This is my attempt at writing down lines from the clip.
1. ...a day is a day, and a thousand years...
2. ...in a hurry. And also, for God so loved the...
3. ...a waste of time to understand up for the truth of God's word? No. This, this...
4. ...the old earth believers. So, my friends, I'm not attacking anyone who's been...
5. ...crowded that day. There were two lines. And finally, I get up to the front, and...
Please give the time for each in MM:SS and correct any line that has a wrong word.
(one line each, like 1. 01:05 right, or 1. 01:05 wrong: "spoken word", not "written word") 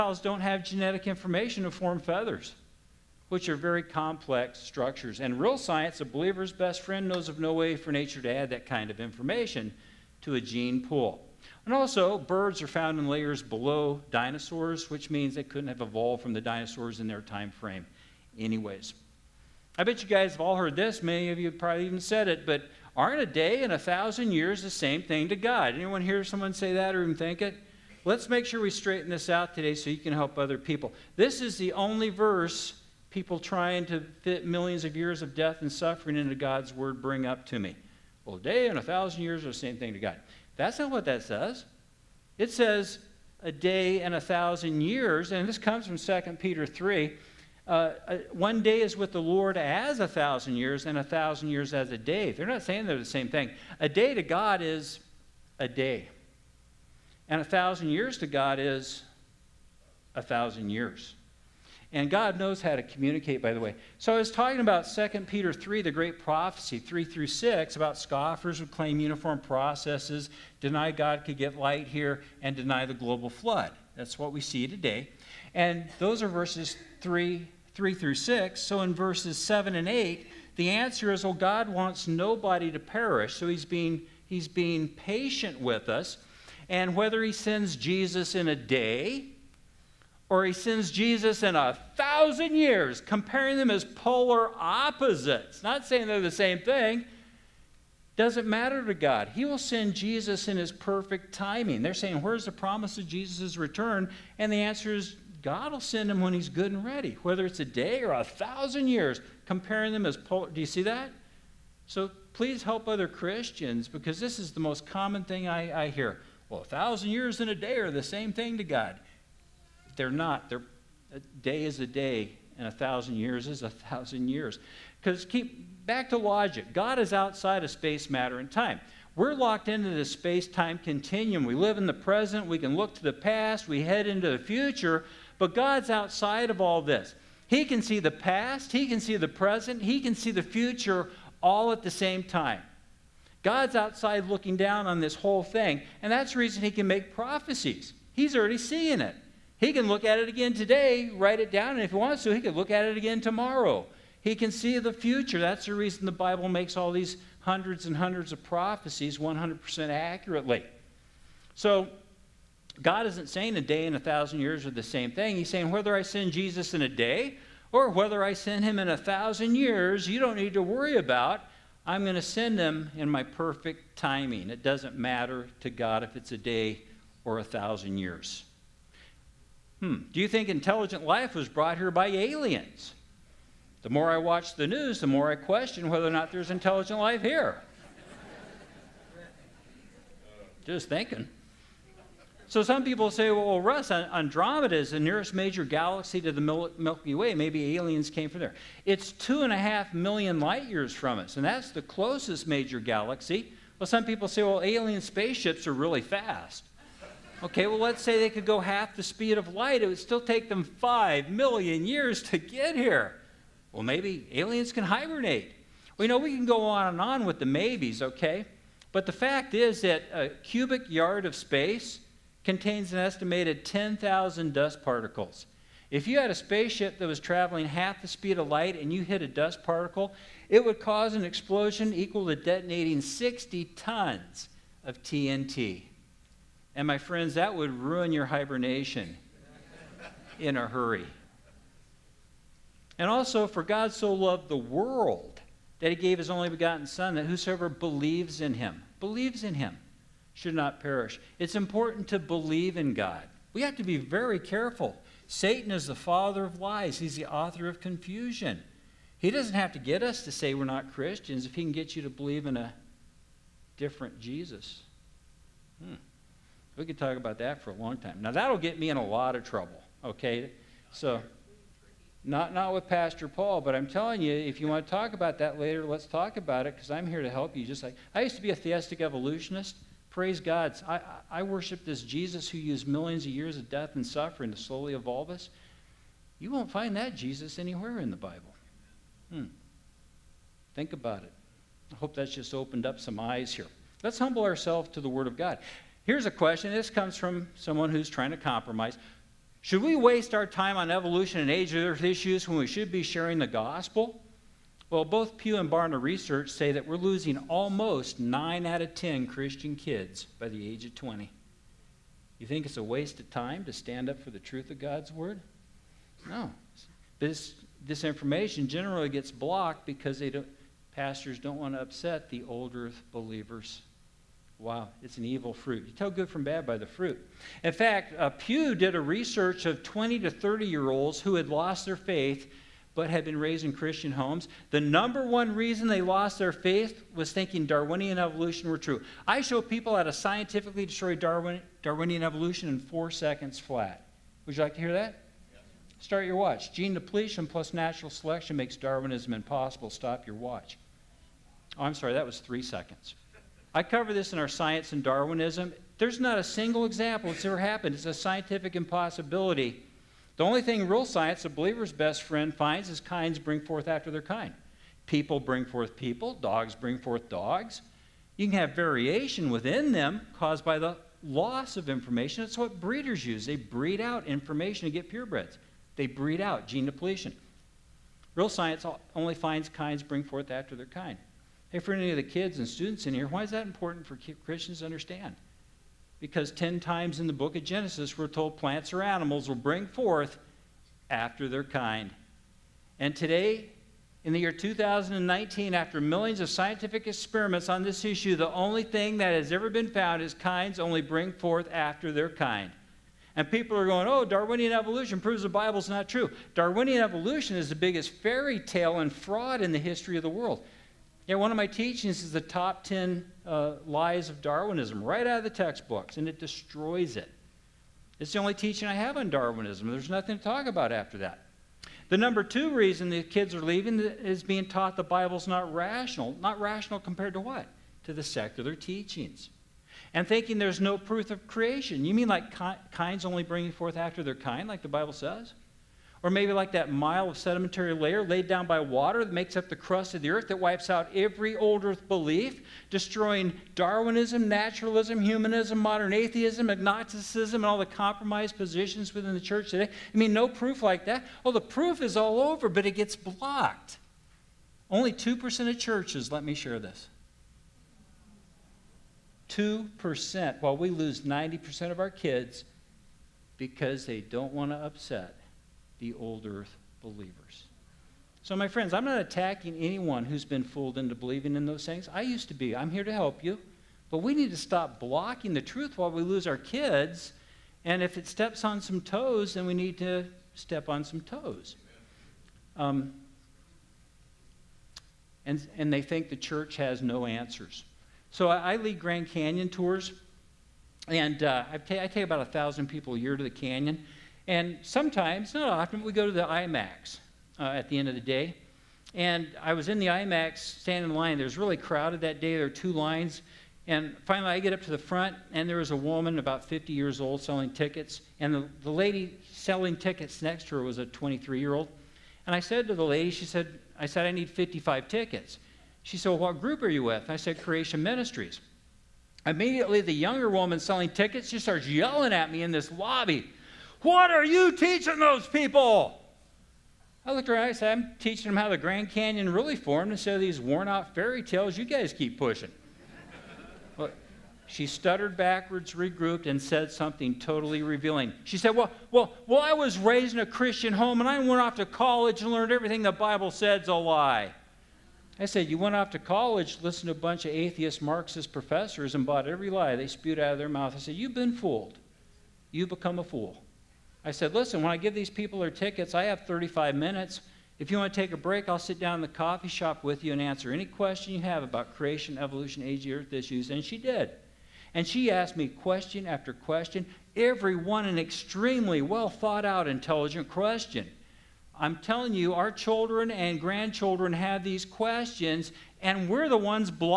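1. 02:01 right
2. 04:00 right
3. 05:12 wrong: "stand", not "understand"
4. 07:46 right
5. 08:21 right.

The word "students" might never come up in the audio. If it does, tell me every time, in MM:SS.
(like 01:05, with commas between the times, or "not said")
06:22.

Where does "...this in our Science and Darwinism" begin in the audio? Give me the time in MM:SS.
05:54.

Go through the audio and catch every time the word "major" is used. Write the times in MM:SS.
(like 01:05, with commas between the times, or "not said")
03:15, 03:22.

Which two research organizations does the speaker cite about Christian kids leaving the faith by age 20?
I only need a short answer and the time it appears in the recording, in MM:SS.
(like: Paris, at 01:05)
Pew and Barna, at 05:05.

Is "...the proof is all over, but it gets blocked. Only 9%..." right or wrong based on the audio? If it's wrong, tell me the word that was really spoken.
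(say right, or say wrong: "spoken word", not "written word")
wrong: "2", not "9".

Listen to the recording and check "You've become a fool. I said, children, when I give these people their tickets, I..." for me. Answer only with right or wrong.
wrong.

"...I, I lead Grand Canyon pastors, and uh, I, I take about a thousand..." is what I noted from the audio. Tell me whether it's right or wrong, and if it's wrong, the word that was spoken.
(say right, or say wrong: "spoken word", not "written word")
wrong: "tours", not "pastors".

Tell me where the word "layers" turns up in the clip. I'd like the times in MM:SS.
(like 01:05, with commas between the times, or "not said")
00:13, 07:17.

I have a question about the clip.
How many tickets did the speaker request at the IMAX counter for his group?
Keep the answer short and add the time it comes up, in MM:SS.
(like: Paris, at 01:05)
55, at 08:34.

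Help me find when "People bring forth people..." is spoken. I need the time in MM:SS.
06:05.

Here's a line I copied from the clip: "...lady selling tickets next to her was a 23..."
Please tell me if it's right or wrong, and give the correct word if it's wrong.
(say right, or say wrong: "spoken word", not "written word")
right.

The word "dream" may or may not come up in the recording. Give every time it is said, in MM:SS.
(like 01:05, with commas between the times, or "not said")
not said.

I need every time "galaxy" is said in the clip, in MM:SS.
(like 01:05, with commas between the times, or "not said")
03:15, 03:22.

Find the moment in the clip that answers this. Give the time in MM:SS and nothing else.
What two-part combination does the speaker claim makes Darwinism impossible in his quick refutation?
05:46.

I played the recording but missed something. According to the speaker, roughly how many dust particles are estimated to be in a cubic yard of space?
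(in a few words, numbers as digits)
10,000.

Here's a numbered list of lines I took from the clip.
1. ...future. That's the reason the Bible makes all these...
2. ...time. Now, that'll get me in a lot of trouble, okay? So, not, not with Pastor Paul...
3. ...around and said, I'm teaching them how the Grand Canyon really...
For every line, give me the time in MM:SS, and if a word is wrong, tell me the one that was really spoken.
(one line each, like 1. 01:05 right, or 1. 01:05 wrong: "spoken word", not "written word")
1. 02:34 right
2. 04:27 right
3. 08:47 right.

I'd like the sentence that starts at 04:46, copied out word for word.
You won't find that Jesus anywhere in the Bible.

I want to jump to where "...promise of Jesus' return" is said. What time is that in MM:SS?
01:42.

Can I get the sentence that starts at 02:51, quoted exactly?
I'm going to send him in my perfect timing.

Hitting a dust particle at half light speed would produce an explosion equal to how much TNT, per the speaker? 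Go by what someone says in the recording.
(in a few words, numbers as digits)
60 tons.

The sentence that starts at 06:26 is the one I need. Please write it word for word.
Because 10 times in the book of Genesis, we're told plants or animals will bring forth after their kind.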